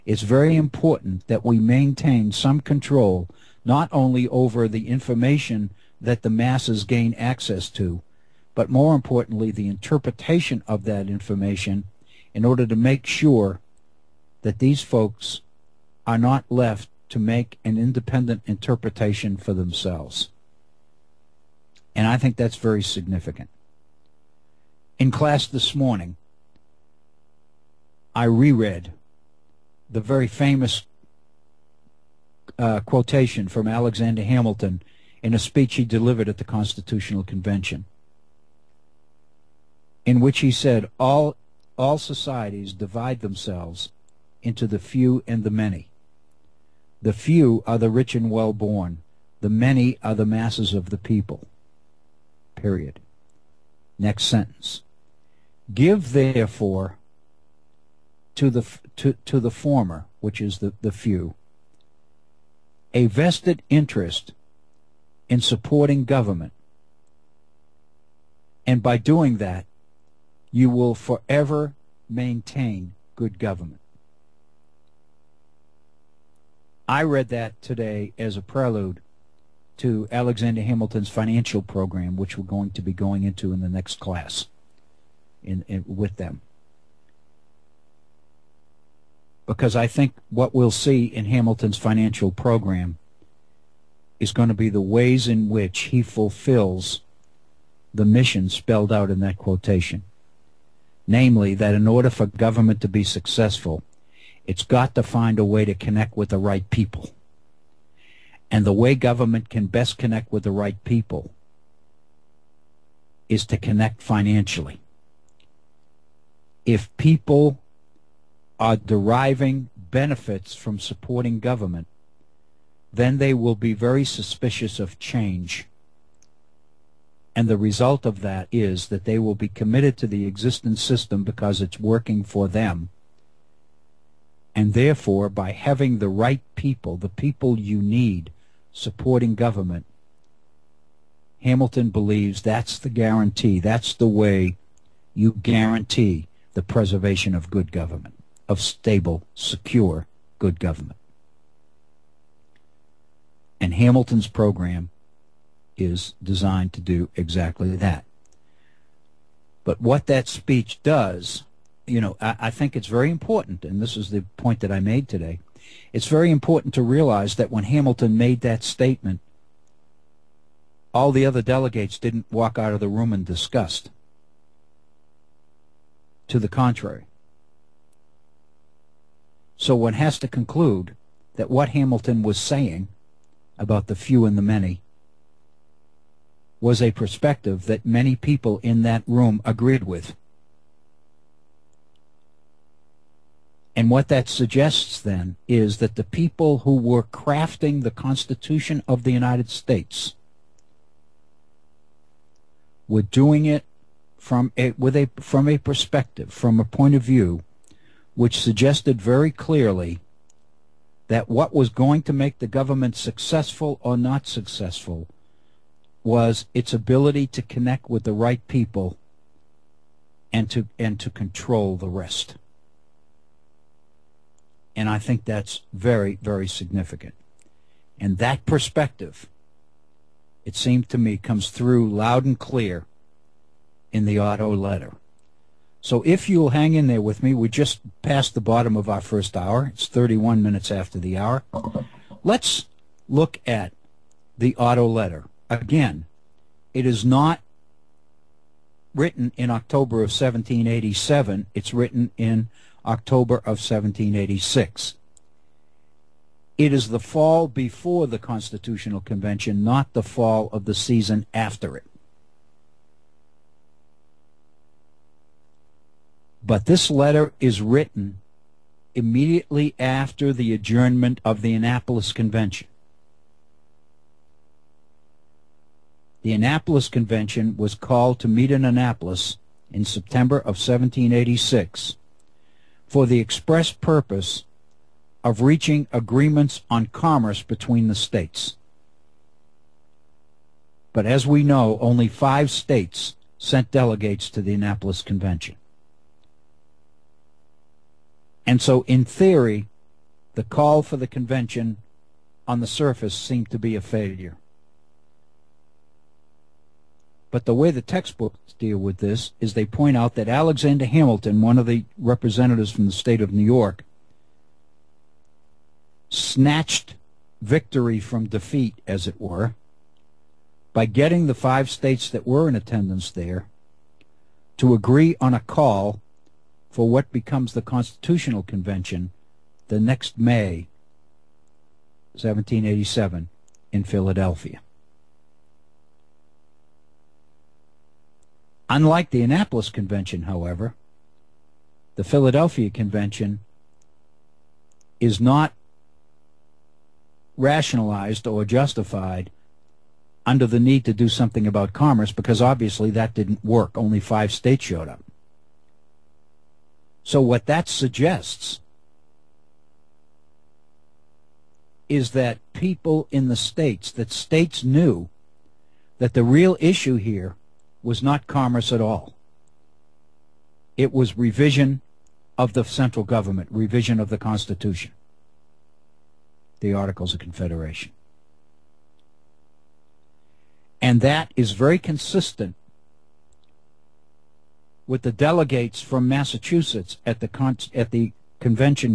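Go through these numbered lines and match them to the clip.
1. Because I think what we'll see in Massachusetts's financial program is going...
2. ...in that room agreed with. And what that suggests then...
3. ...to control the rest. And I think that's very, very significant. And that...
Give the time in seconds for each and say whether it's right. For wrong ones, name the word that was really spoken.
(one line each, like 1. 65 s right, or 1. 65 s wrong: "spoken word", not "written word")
1. 89 s wrong: "Hamilton", not "Massachusetts"
2. 188 s right
3. 220 s right.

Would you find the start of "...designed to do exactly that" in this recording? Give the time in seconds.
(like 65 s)
156 s.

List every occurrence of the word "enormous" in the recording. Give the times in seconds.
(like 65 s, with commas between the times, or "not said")
not said.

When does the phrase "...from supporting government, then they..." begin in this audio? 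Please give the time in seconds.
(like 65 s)
120 s.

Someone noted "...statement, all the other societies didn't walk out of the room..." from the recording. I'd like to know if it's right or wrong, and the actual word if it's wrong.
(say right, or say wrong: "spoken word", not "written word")
wrong: "delegates", not "societies".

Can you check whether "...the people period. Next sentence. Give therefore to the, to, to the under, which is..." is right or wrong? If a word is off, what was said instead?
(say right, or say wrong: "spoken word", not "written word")
wrong: "former", not "under".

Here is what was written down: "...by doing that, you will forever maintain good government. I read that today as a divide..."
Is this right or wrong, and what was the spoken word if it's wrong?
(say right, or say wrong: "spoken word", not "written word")
wrong: "prelude", not "divide".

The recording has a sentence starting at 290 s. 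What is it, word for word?
But as we know, only five states sent delegates to the Annapolis Convention.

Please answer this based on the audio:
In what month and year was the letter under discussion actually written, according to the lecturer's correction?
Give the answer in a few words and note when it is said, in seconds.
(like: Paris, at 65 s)
October 1786, at 252 s.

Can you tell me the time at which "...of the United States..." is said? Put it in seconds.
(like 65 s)
198 s.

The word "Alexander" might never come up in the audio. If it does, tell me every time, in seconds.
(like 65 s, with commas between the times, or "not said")
33 s, 80 s, 310 s.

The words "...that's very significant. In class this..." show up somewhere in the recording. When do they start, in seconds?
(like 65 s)
22 s.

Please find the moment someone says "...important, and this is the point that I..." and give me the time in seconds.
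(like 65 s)
163 s.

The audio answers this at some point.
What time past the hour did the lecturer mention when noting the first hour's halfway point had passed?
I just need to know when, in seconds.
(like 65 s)
239 s.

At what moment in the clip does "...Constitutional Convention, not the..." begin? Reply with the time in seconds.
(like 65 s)
258 s.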